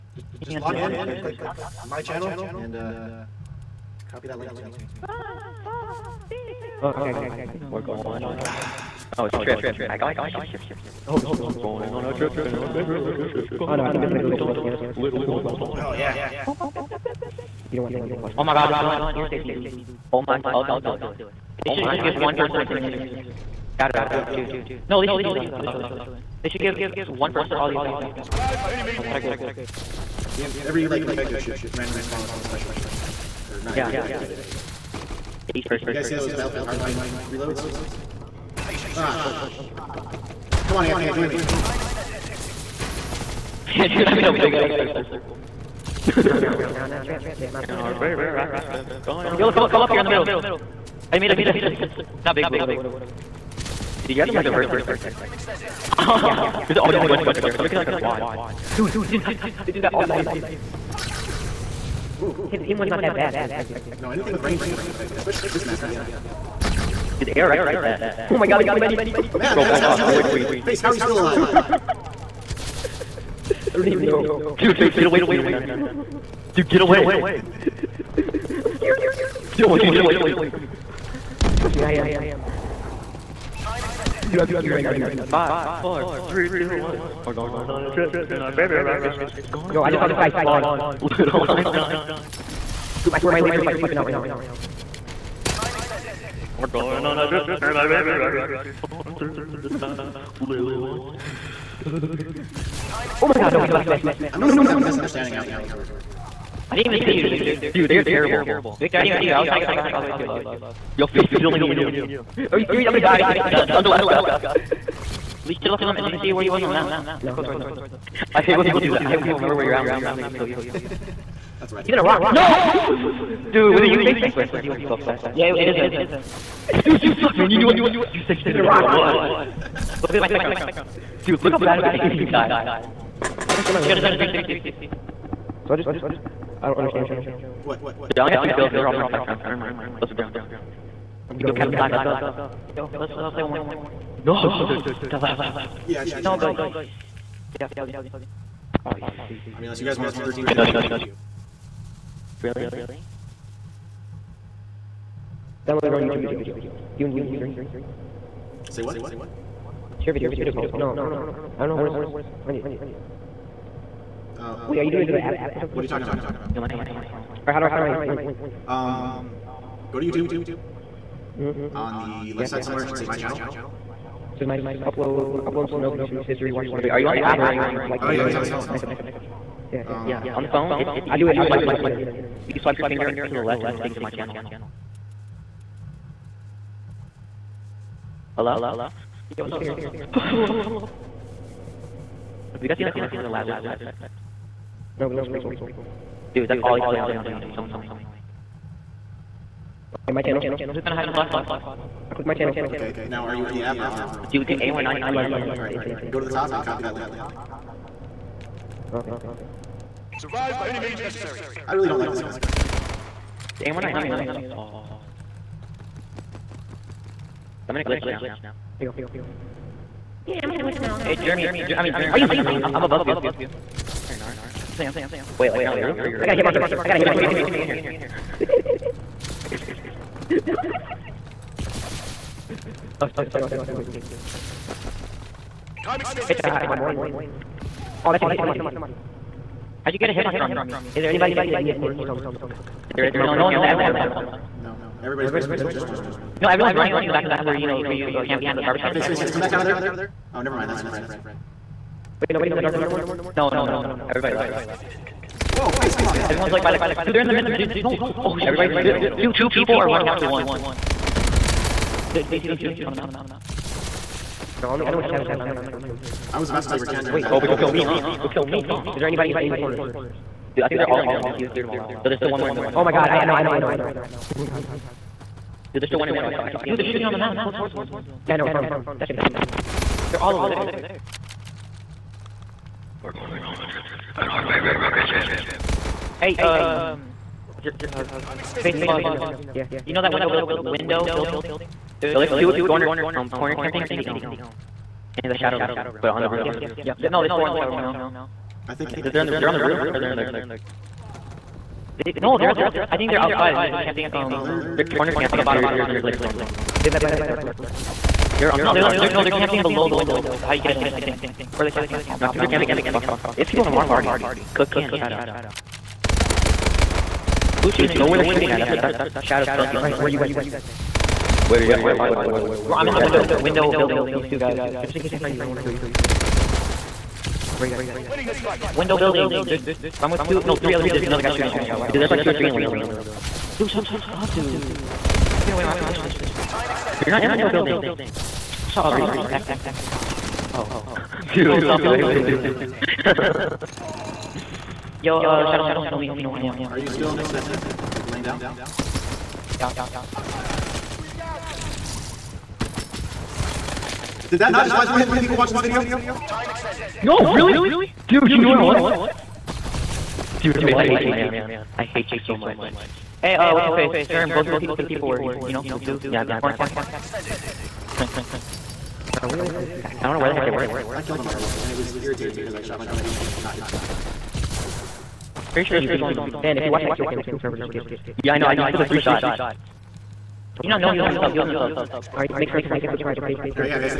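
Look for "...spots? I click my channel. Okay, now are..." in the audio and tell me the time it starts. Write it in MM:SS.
03:21.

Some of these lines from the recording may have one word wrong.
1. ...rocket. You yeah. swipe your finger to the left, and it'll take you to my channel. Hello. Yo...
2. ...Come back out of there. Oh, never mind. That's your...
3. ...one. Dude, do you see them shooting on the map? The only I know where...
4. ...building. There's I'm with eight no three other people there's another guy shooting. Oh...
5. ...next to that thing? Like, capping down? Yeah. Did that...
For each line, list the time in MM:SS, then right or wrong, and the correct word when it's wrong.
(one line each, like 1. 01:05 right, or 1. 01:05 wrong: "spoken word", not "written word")
1. 03:01 wrong: "internet", not "rocket"
2. 04:09 right
3. 04:20 right
4. 05:28 wrong: "two", not "eight"
5. 05:47 wrong: "laying", not "capping".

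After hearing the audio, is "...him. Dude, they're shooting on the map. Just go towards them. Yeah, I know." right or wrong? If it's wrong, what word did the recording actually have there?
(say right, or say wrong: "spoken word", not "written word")
right.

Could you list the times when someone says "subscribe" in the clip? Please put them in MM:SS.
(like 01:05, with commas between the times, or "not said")
02:58, 06:22.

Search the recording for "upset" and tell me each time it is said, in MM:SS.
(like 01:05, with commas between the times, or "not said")
02:04.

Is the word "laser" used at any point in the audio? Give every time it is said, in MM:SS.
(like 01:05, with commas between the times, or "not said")
00:22, 01:33.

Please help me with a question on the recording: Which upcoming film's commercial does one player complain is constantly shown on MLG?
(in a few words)
The Lazarus Effect.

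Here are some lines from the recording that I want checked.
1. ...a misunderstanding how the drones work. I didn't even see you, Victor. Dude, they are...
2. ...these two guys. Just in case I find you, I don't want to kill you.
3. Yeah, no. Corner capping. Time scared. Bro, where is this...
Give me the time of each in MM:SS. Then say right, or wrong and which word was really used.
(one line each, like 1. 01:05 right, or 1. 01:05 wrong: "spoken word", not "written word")
1. 01:44 right
2. 05:24 right
3. 06:06 wrong: "extended", not "scared".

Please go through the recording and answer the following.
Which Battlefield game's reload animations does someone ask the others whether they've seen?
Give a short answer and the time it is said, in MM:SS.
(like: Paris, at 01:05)
Battlefield Hardline, at 00:36.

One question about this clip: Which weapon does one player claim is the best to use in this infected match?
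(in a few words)
ARX.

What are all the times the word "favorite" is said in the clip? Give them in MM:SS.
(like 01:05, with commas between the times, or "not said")
00:12, 00:47, 01:28, 01:37, 04:44.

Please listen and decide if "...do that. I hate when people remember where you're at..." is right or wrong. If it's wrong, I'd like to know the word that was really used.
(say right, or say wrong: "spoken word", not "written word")
right.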